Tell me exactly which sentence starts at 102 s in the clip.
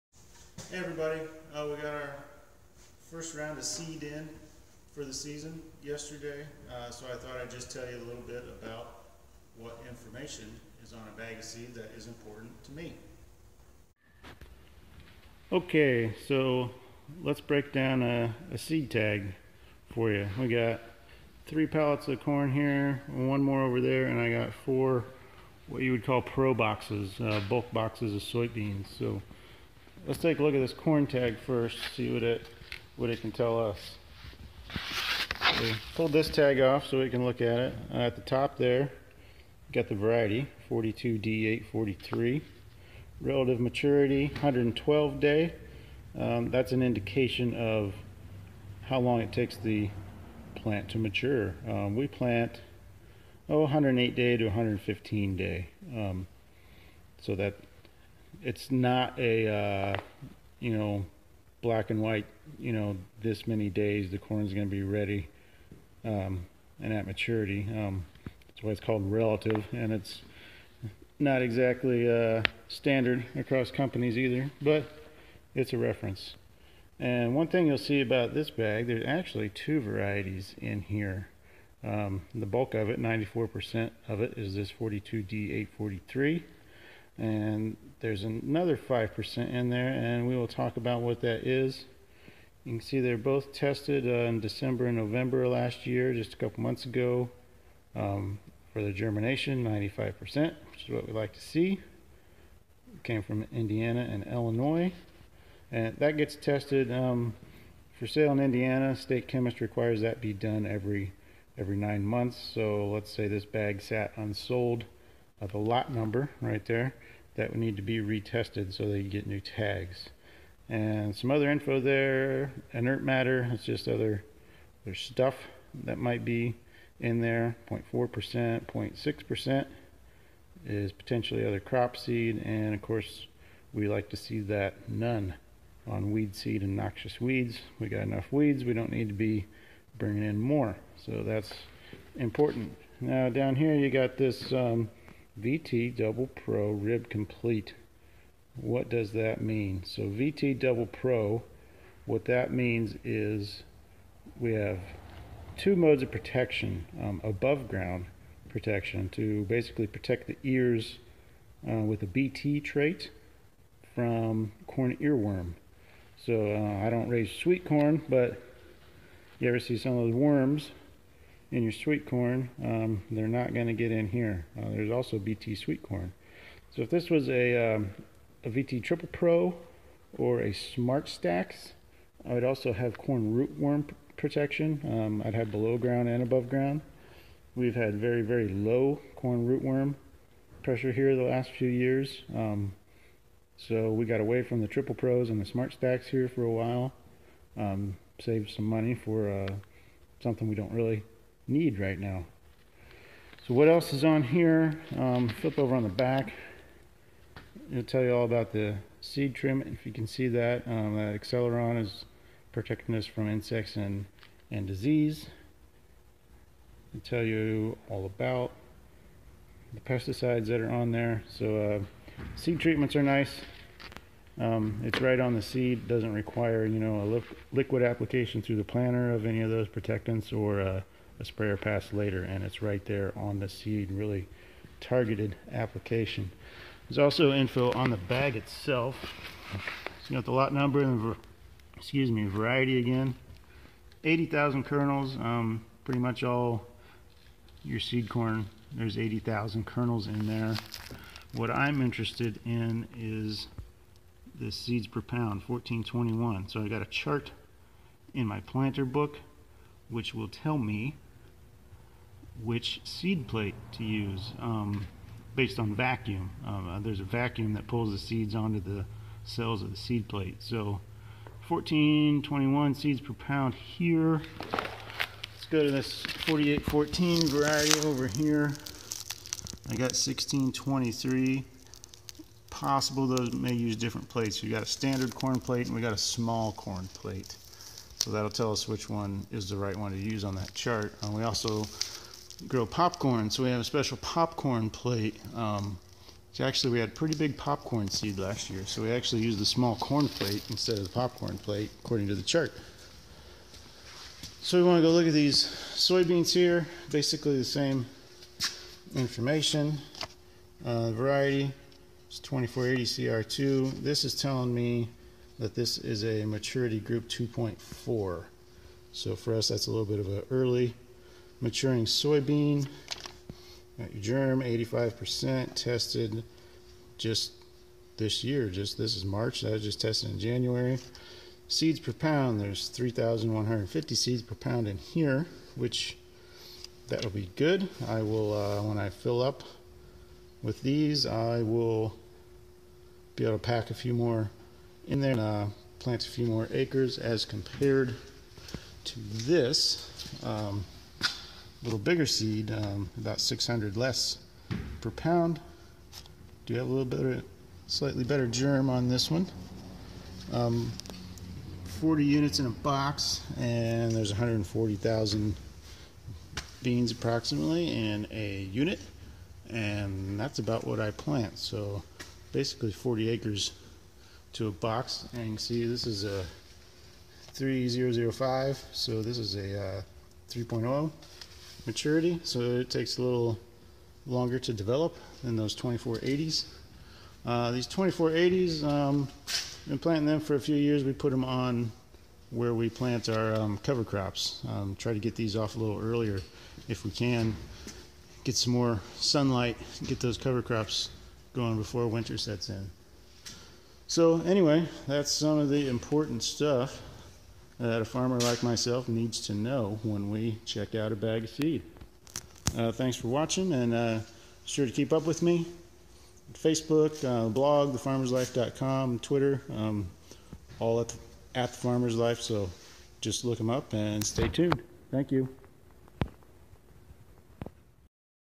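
It came from Indiana and Illinois.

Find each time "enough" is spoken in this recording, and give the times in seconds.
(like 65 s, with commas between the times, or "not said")
138 s.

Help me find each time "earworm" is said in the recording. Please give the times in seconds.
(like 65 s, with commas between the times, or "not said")
164 s.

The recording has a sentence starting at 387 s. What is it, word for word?
Uh, these 2480s, um, been planting them for a few years.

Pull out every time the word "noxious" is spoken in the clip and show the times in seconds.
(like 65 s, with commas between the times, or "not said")
136 s.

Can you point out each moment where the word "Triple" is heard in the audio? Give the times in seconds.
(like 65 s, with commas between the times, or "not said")
178 s, 194 s.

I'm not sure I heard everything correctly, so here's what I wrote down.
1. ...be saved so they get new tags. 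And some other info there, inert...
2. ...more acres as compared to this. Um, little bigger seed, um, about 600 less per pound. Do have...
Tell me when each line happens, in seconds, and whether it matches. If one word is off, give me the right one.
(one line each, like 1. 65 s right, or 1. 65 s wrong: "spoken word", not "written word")
1. 117 s wrong: "retested", not "saved"
2. 346 s right.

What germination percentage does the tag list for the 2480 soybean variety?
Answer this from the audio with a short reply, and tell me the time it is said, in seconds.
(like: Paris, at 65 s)
85%, at 324 s.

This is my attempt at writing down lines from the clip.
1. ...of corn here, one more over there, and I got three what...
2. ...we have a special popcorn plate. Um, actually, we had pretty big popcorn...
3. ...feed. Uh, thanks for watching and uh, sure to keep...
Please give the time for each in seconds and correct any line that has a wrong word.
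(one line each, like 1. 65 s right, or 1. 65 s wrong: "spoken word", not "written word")
1. 22 s wrong: "four", not "three"
2. 293 s right
3. 411 s right.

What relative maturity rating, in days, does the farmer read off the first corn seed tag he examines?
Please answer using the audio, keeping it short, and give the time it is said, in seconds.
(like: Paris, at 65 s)
112 day, at 44 s.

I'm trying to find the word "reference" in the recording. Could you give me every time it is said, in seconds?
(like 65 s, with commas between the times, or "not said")
75 s.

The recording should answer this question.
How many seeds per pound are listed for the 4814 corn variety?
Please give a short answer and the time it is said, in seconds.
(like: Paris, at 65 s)
1623, at 279 s.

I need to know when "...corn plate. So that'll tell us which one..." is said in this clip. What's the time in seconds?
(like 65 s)
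286 s.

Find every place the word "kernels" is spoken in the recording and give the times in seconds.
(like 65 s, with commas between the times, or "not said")
244 s, 249 s.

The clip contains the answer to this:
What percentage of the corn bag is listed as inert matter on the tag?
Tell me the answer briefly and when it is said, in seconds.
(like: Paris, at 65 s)
0.4%, at 127 s.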